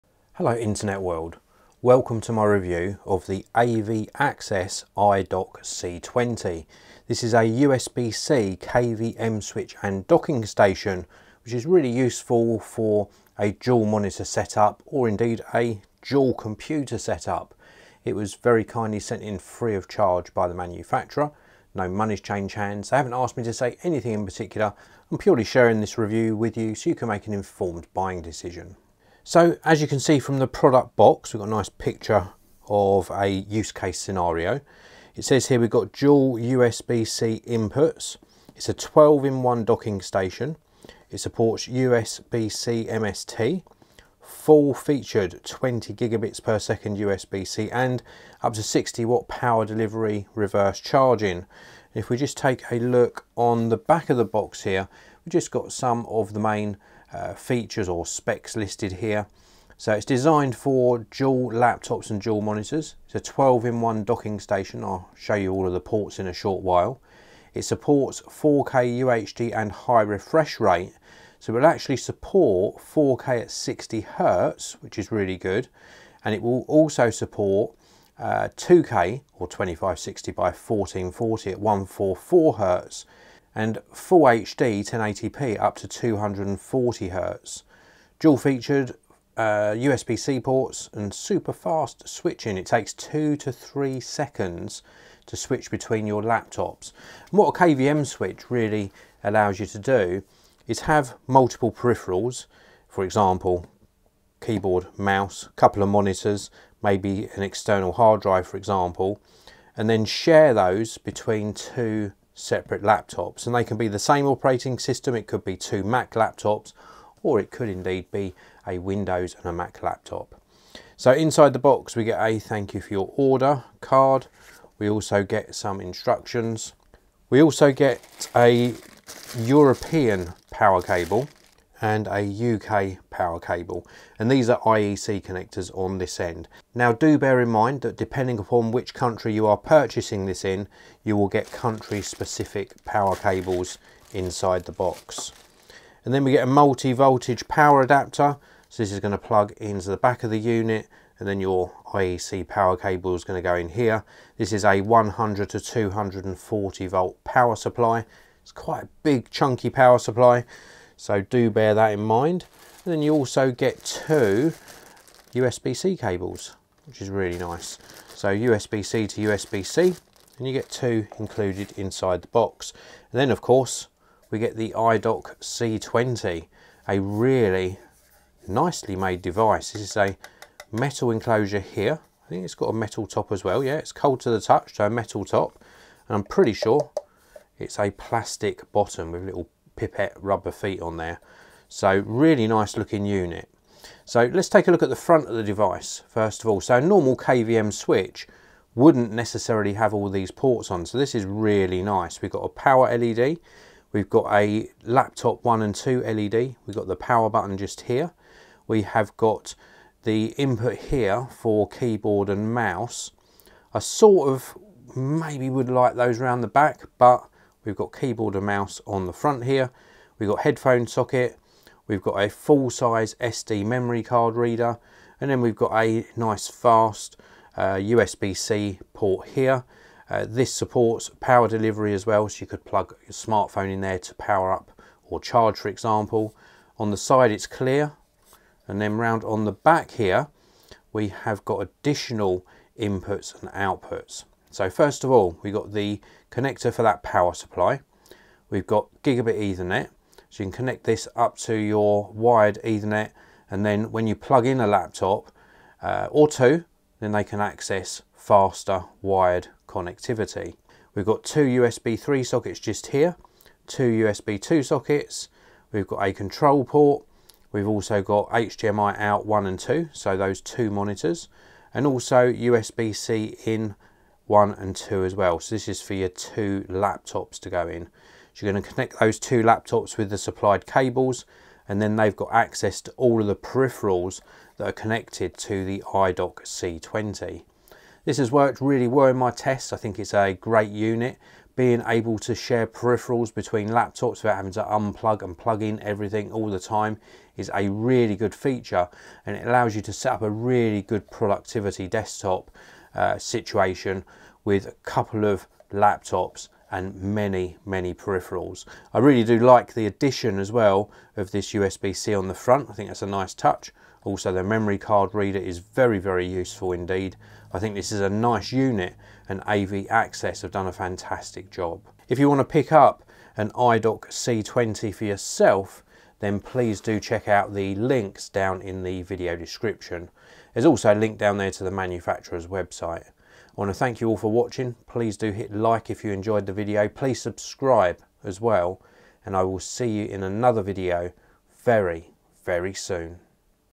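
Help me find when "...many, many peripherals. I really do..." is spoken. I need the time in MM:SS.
05:06.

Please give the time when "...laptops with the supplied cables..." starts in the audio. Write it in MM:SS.
04:39.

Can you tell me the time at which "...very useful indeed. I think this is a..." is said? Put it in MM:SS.
05:15.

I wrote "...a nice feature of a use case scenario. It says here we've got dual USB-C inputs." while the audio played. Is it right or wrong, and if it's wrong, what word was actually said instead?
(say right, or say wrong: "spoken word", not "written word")
wrong: "picture", not "feature".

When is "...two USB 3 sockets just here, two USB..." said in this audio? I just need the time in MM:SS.
04:21.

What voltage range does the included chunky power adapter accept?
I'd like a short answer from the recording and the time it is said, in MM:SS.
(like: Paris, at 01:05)
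100 to 240 volts, at 02:34.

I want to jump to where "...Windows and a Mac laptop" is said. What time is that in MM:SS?
01:58.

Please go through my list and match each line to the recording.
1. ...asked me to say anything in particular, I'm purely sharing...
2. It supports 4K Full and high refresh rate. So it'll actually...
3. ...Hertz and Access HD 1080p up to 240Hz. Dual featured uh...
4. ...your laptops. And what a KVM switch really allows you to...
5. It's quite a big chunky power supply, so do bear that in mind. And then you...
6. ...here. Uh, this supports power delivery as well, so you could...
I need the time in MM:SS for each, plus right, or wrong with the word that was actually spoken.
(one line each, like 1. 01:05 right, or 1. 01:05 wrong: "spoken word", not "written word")
1. 00:23 right
2. 01:07 wrong: "UHD", not "Full"
3. 01:22 wrong: "Full", not "Access"
4. 01:36 right
5. 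02:38 right
6. 03:49 right.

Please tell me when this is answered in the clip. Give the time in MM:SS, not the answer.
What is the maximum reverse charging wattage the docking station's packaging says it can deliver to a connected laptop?
00:48.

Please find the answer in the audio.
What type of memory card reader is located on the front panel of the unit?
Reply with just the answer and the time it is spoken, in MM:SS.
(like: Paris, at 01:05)
Full-size SD, at 03:42.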